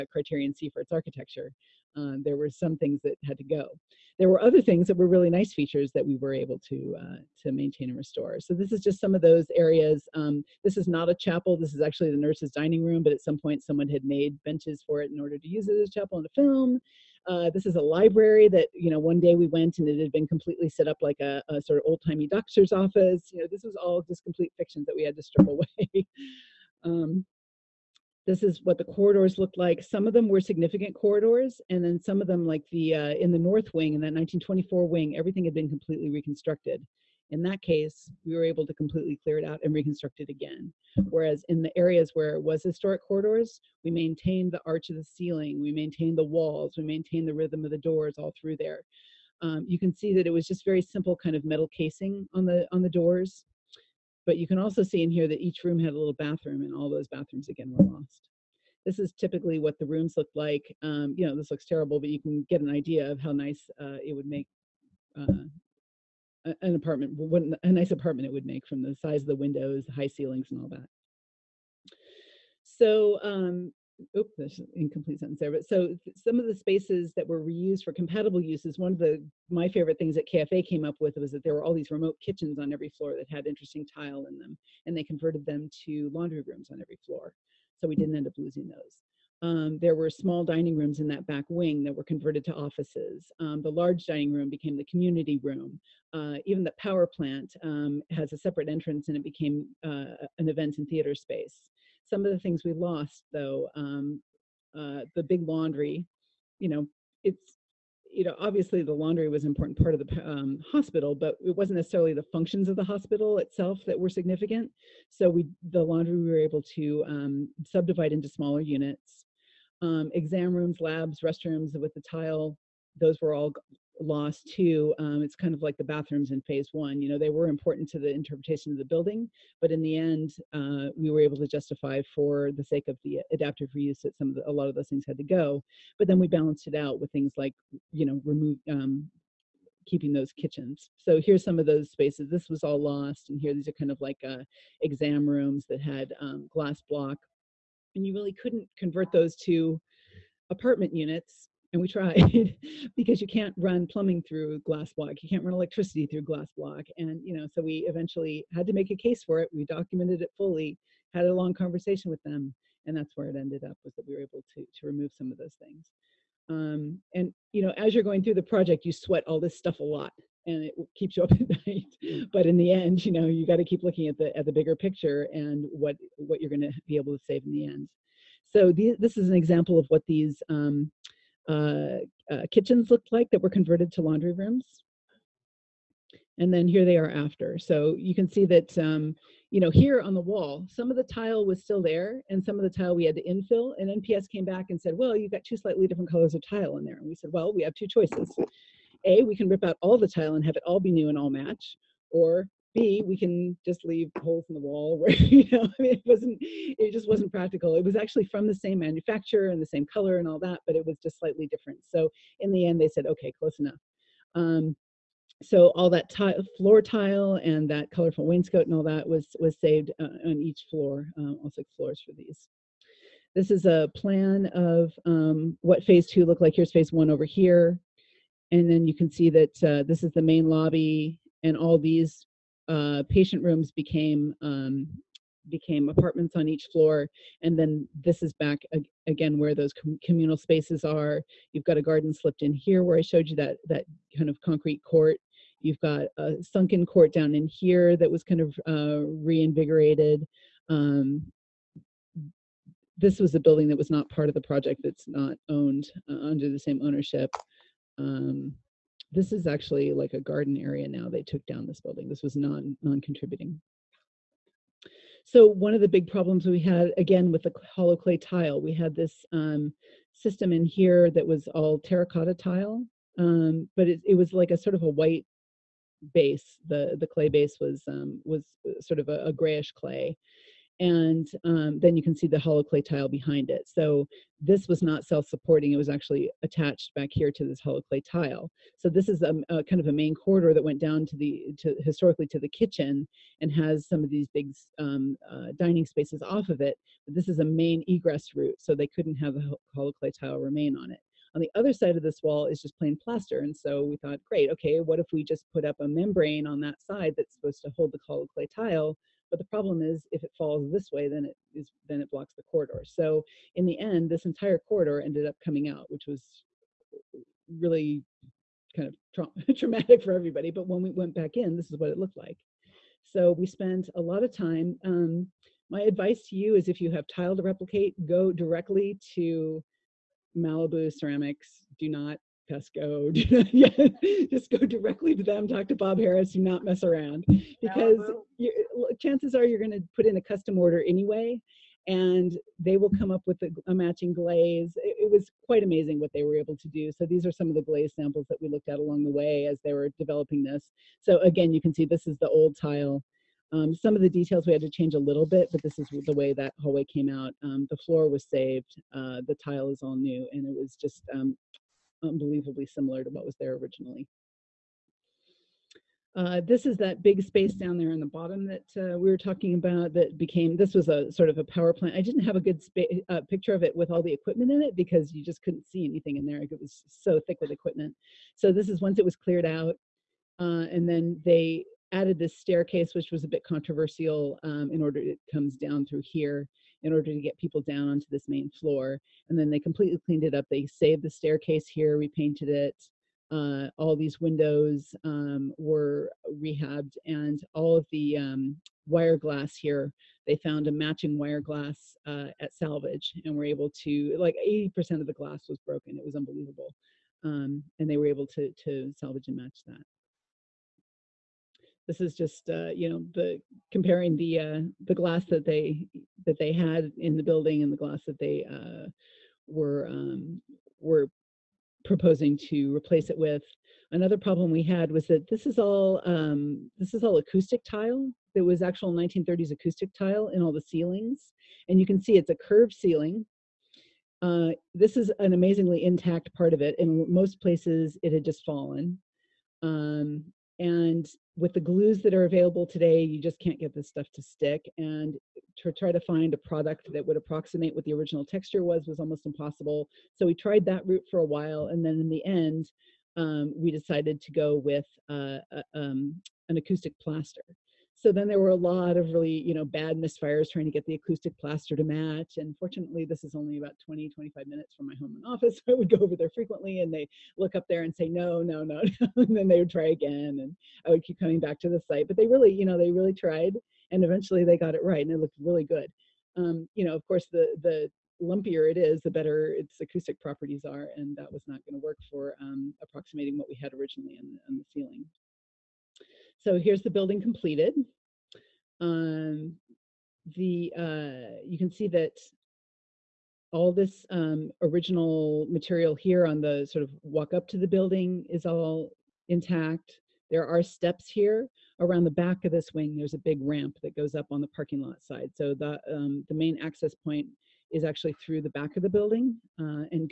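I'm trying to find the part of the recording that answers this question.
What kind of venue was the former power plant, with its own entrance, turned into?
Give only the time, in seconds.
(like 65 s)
100 s.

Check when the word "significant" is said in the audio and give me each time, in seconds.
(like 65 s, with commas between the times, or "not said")
30 s, 114 s.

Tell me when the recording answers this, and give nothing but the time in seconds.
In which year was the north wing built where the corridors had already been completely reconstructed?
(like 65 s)
34 s.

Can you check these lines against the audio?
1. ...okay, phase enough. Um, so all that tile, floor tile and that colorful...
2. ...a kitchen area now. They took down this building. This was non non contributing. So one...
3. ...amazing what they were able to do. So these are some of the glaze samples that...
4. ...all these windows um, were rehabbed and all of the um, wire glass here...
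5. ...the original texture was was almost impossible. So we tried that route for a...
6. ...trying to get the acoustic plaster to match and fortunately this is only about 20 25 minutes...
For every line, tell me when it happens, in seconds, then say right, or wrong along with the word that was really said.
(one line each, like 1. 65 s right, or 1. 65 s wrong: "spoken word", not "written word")
1. 213 s wrong: "close", not "phase"
2. 260 s wrong: "garden", not "kitchen"
3. 345 s right
4. 393 s right
5. 447 s right
6. 460 s right.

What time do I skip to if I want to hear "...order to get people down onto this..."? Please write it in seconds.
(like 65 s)
386 s.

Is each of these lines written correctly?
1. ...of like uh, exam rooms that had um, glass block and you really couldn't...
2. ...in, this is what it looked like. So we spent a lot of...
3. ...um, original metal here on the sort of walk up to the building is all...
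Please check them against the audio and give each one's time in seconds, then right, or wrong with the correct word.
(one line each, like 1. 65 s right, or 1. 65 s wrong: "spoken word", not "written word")
1. 143 s right
2. 321 s right
3. 494 s wrong: "material", not "metal".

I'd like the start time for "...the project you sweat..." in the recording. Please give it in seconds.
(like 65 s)
168 s.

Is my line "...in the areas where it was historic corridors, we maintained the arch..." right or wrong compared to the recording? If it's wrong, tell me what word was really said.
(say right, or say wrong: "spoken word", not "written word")
right.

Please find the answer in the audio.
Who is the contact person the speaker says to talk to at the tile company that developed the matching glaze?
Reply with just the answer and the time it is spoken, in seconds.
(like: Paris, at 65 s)
Bob Harris, at 335 s.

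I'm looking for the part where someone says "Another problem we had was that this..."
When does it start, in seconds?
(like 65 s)
423 s.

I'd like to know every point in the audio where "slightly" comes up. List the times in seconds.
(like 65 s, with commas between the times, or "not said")
195 s, 211 s.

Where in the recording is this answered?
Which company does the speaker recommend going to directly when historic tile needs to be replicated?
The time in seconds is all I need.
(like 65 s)
330 s.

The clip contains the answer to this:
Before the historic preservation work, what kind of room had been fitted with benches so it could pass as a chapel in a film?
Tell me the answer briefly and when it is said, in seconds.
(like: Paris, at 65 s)
nurses' dining room, at 12 s.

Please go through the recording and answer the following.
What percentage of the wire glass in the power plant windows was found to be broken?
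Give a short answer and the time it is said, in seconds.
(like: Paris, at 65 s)
80%, at 404 s.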